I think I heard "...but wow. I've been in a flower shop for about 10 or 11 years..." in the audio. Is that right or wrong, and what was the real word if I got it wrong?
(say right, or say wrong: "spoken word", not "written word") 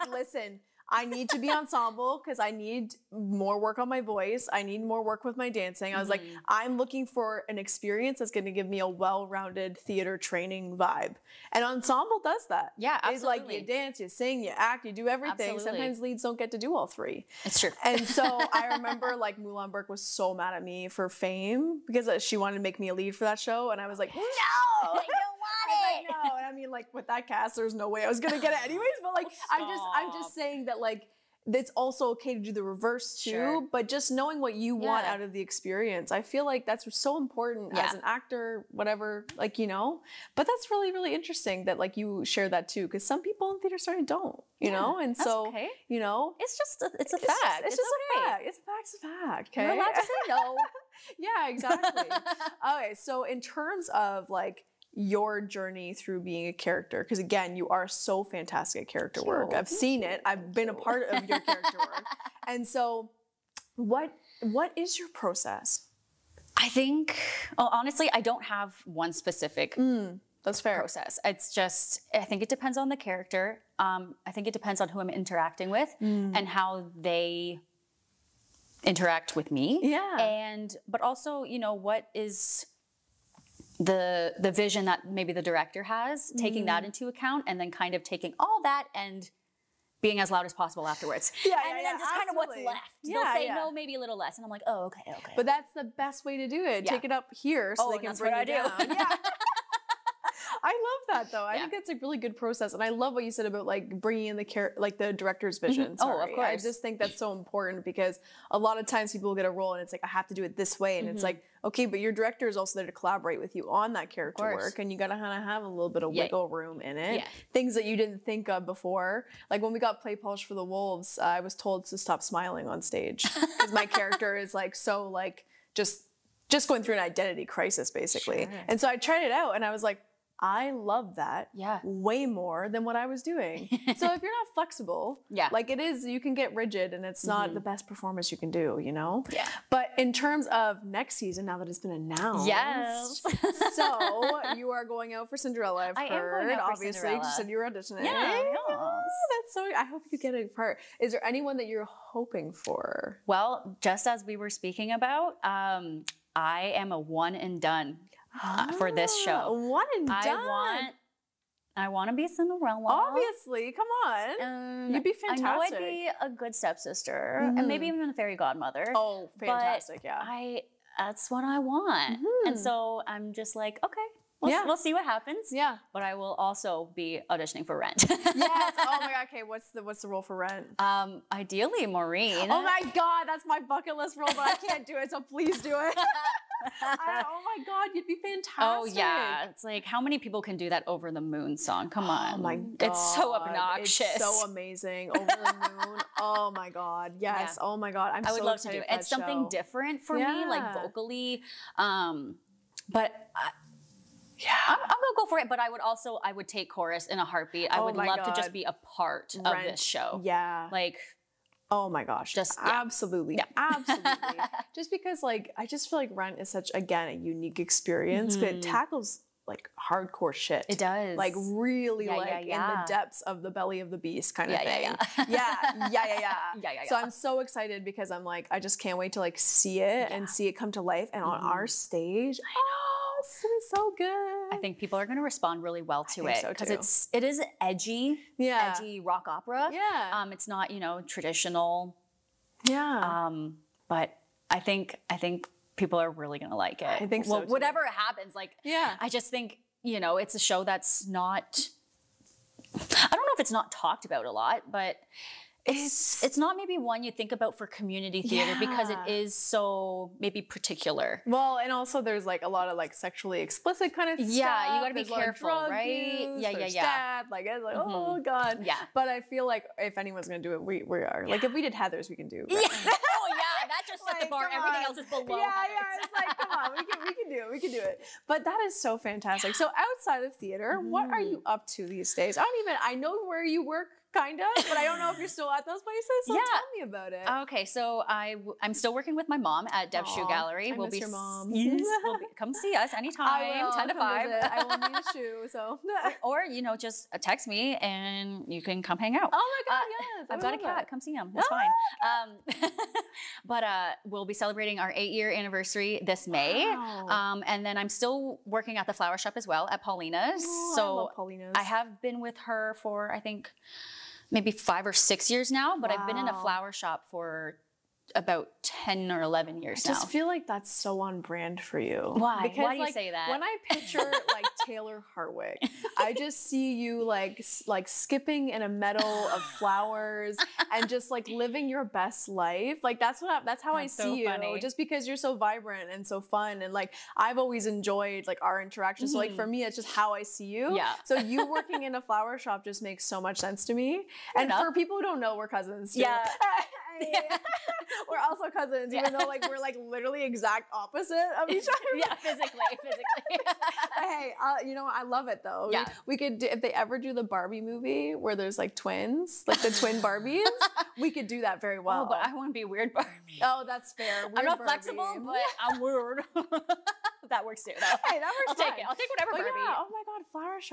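right.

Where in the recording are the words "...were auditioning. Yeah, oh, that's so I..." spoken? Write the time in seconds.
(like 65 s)
147 s.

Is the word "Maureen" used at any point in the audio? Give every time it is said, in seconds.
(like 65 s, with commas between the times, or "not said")
181 s.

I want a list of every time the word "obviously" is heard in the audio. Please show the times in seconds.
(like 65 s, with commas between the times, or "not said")
146 s, 162 s.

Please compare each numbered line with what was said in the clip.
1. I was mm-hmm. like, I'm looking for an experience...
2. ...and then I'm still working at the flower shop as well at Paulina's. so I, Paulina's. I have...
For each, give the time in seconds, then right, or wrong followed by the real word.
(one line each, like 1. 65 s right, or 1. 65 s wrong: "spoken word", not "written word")
1. 5 s right
2. 307 s right.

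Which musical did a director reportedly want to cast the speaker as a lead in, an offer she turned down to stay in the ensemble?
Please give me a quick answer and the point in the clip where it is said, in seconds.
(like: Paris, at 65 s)
Fame, at 21 s.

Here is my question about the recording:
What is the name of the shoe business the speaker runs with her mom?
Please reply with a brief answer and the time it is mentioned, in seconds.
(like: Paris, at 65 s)
Dev Shoe Gallery, at 289 s.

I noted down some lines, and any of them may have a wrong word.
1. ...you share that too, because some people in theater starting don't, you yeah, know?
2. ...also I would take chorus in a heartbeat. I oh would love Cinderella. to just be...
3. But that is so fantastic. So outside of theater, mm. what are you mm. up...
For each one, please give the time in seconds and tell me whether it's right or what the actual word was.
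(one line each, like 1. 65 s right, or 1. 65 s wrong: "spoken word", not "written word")
1. 41 s right
2. 205 s wrong: "God", not "Cinderella"
3. 278 s right.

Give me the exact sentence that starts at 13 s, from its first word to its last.
It's like you dance, you sing, you act, you do everything.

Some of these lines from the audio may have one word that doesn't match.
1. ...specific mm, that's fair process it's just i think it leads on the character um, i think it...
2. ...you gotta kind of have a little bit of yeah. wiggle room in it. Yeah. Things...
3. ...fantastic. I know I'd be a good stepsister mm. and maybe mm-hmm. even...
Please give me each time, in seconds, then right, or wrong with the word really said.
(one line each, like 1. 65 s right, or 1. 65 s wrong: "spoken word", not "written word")
1. 69 s wrong: "depends", not "leads"
2. 114 s right
3. 165 s right.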